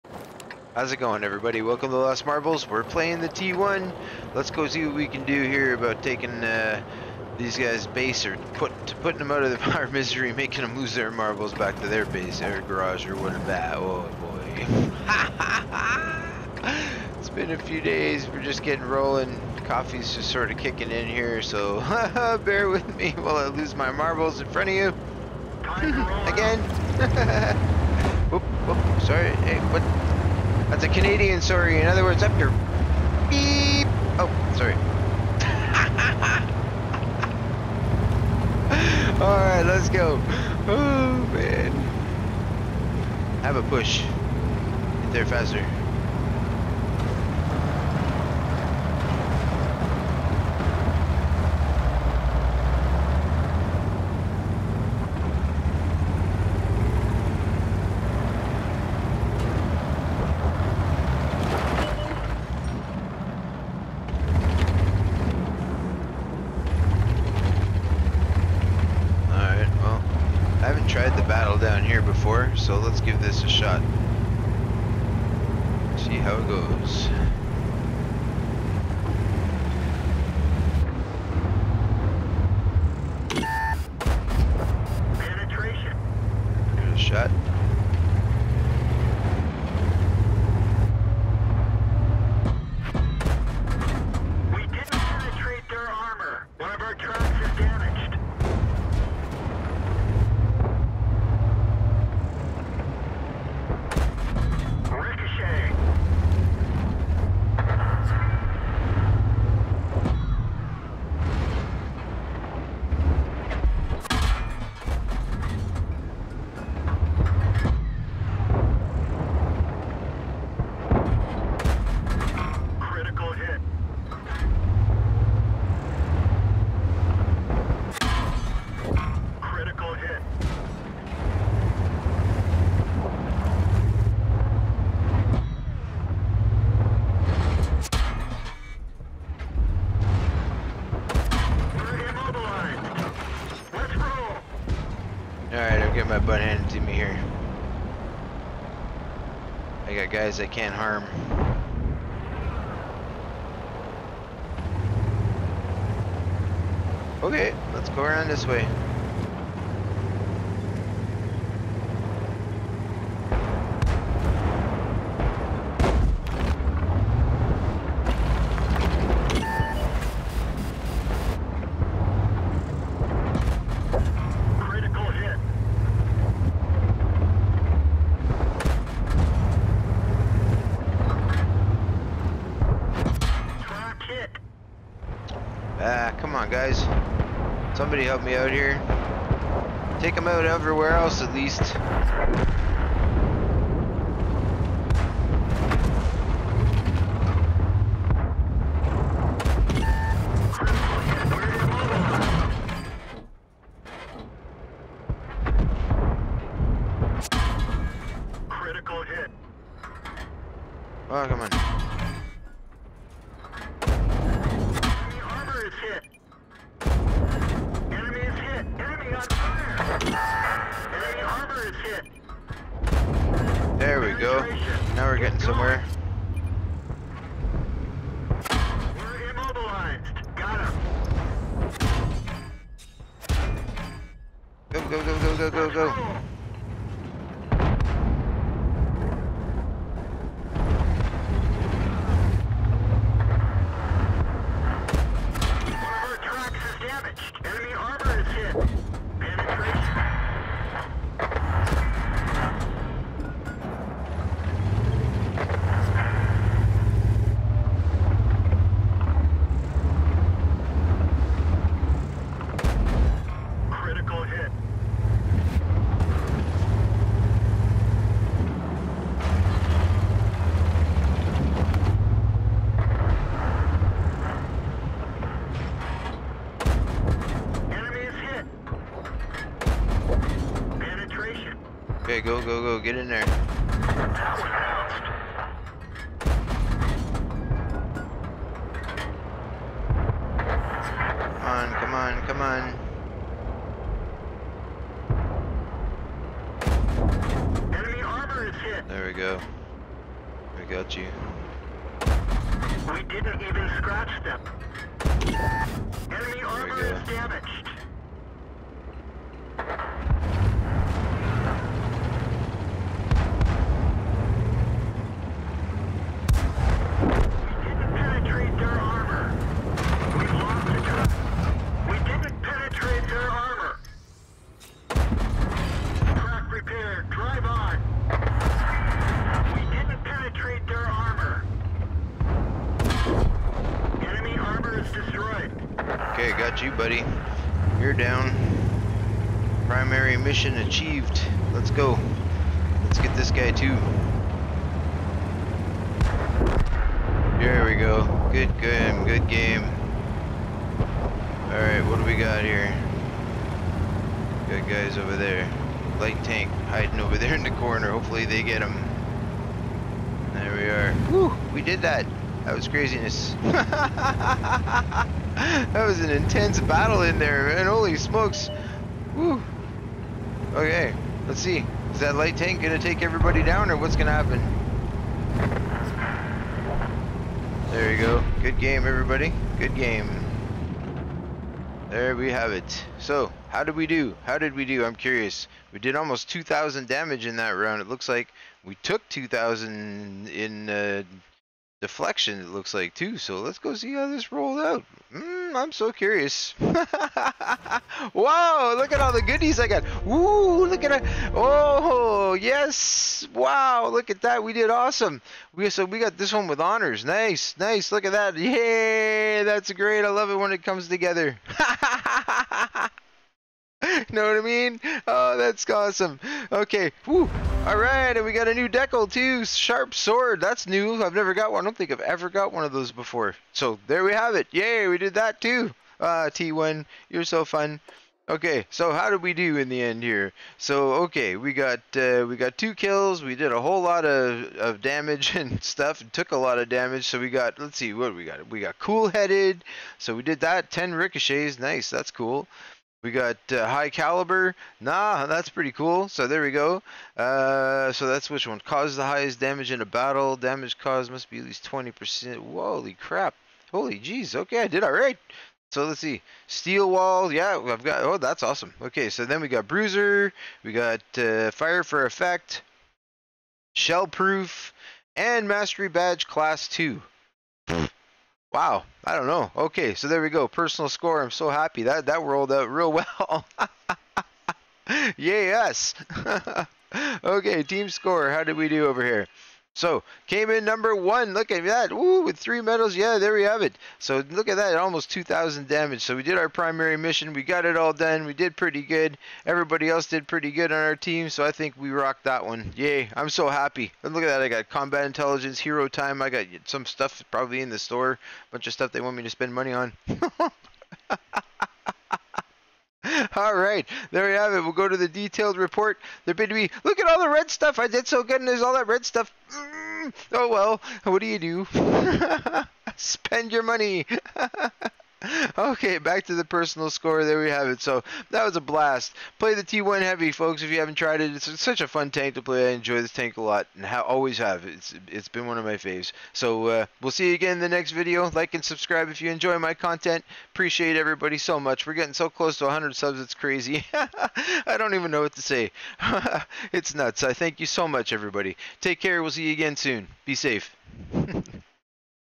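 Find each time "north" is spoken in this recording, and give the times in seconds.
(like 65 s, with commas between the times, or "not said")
not said.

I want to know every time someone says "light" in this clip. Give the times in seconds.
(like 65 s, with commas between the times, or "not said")
355 s, 372 s.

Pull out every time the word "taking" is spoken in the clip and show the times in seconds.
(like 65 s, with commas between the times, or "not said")
6 s.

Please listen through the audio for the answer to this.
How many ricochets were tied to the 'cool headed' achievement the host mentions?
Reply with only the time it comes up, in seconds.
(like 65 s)
440 s.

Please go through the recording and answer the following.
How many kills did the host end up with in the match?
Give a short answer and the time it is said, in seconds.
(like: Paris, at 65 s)
2, at 432 s.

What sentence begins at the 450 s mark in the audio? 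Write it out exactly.
Damage caused must be at least 20%.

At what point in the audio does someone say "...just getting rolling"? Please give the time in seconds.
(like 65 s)
18 s.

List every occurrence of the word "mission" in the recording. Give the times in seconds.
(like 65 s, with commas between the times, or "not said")
340 s, 486 s.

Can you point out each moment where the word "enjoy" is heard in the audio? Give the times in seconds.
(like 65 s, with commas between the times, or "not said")
522 s, 529 s.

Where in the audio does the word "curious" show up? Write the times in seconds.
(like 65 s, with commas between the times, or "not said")
384 s, 395 s.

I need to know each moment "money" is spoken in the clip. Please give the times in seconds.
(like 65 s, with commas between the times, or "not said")
499 s, 513 s.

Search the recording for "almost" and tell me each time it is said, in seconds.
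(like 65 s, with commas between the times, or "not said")
385 s, 484 s.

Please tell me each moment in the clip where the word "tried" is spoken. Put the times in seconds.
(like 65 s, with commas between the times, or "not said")
70 s, 520 s.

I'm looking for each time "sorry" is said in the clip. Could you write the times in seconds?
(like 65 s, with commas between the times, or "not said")
29 s, 34 s.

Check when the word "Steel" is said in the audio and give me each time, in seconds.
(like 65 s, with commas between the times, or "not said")
456 s.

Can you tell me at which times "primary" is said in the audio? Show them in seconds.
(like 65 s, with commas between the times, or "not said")
339 s, 486 s.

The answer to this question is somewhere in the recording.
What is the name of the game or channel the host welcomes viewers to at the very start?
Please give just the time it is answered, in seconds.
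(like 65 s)
1 s.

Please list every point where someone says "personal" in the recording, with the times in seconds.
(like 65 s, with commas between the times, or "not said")
470 s, 516 s.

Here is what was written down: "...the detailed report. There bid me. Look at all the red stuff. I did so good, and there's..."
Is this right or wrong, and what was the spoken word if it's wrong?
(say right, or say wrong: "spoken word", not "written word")
right.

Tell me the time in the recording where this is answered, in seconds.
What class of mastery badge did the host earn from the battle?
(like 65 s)
466 s.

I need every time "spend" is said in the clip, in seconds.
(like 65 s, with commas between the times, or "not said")
499 s, 512 s.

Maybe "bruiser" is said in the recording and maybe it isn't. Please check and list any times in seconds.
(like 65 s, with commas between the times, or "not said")
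459 s.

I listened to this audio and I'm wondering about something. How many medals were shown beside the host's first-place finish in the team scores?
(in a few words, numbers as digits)
3.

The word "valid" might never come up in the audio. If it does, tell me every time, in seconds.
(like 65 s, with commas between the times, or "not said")
not said.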